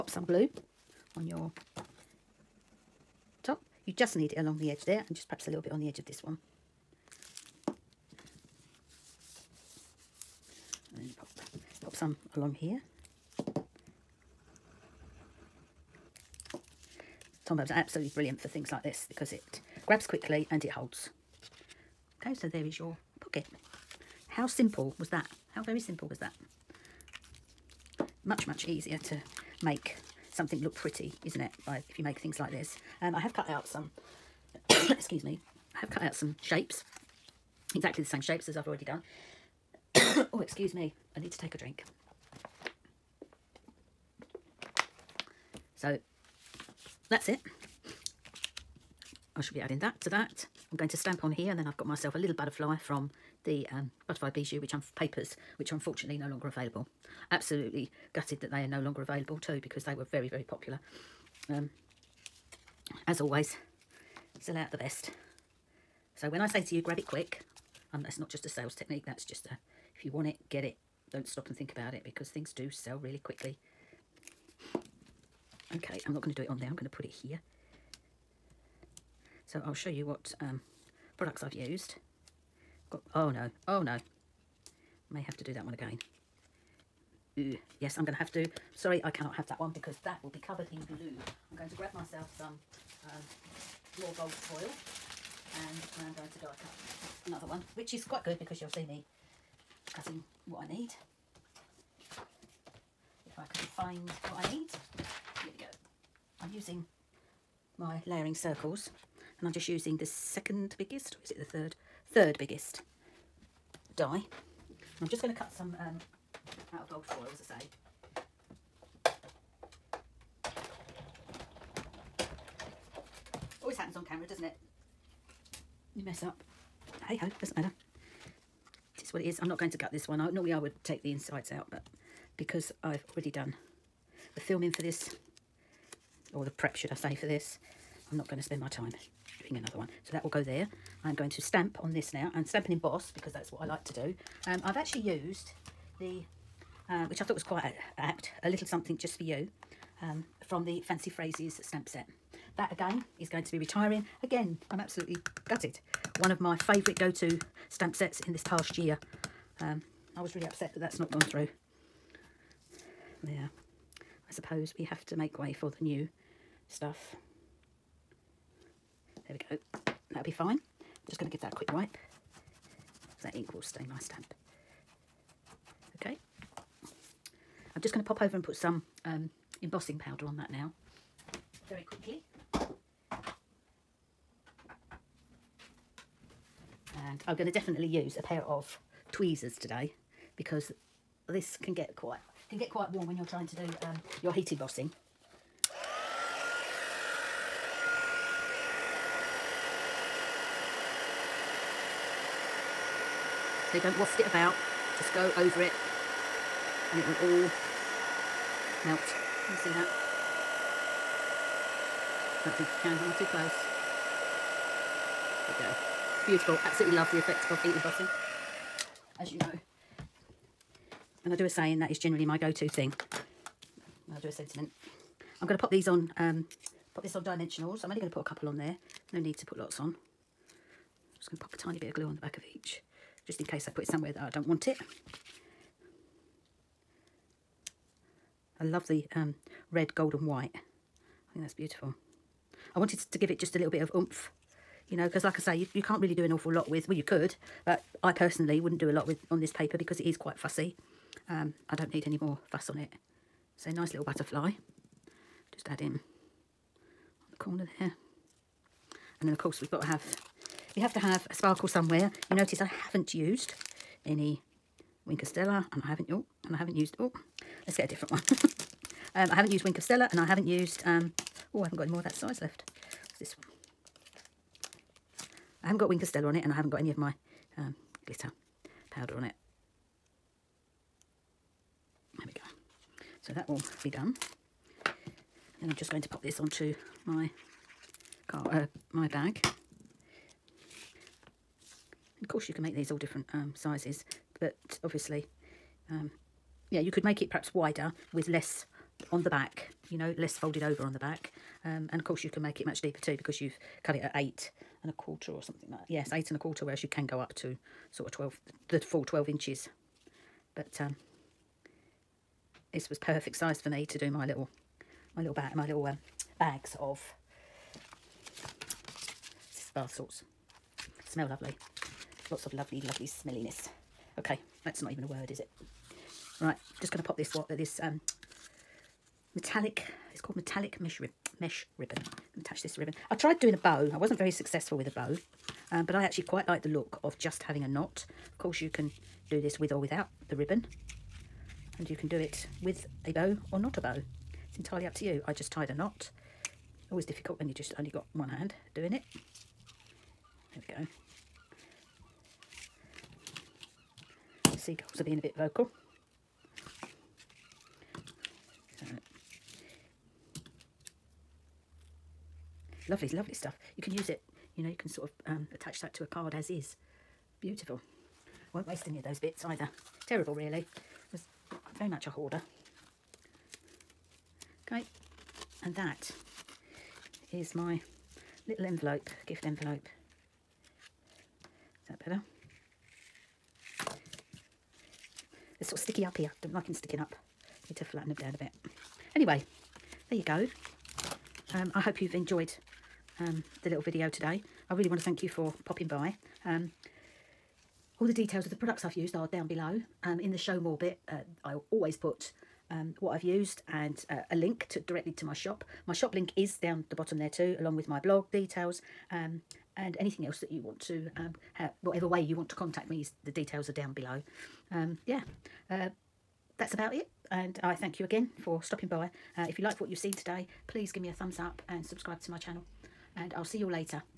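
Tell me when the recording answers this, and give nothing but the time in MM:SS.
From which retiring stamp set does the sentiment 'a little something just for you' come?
02:30.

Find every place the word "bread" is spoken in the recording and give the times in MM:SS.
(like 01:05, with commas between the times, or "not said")
not said.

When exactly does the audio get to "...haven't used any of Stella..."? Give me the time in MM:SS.
04:22.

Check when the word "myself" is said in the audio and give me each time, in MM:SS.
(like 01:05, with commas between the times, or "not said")
00:51, 01:31.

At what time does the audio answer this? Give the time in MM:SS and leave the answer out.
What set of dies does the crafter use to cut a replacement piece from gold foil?
01:48.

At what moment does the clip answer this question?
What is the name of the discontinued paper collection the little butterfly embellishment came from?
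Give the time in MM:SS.
00:54.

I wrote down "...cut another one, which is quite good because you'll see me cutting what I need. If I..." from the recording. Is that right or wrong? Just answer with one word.
right.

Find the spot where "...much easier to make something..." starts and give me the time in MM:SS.
00:28.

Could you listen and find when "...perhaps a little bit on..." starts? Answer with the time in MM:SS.
00:05.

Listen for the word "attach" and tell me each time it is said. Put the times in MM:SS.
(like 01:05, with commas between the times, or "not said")
05:32, 06:05.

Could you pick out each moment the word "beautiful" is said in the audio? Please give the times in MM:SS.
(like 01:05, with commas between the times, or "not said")
03:36, 04:01, 06:07.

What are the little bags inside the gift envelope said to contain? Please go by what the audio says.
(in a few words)
bath salts.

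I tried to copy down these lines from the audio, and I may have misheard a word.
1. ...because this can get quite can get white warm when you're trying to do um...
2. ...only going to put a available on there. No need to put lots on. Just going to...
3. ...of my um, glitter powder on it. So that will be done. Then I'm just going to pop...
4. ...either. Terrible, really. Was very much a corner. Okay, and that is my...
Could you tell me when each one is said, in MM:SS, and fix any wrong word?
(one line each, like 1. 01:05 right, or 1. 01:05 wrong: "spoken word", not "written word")
1. 03:10 wrong: "quite", not "white"
2. 03:47 wrong: "couple", not "available"
3. 04:36 right
4. 06:09 wrong: "hoarder", not "corner".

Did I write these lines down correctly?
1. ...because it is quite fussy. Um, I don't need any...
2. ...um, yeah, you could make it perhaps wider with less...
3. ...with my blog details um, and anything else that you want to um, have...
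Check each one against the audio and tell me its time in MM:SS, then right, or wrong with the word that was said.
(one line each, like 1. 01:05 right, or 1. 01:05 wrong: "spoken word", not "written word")
1. 04:09 right
2. 04:55 right
3. 06:47 right.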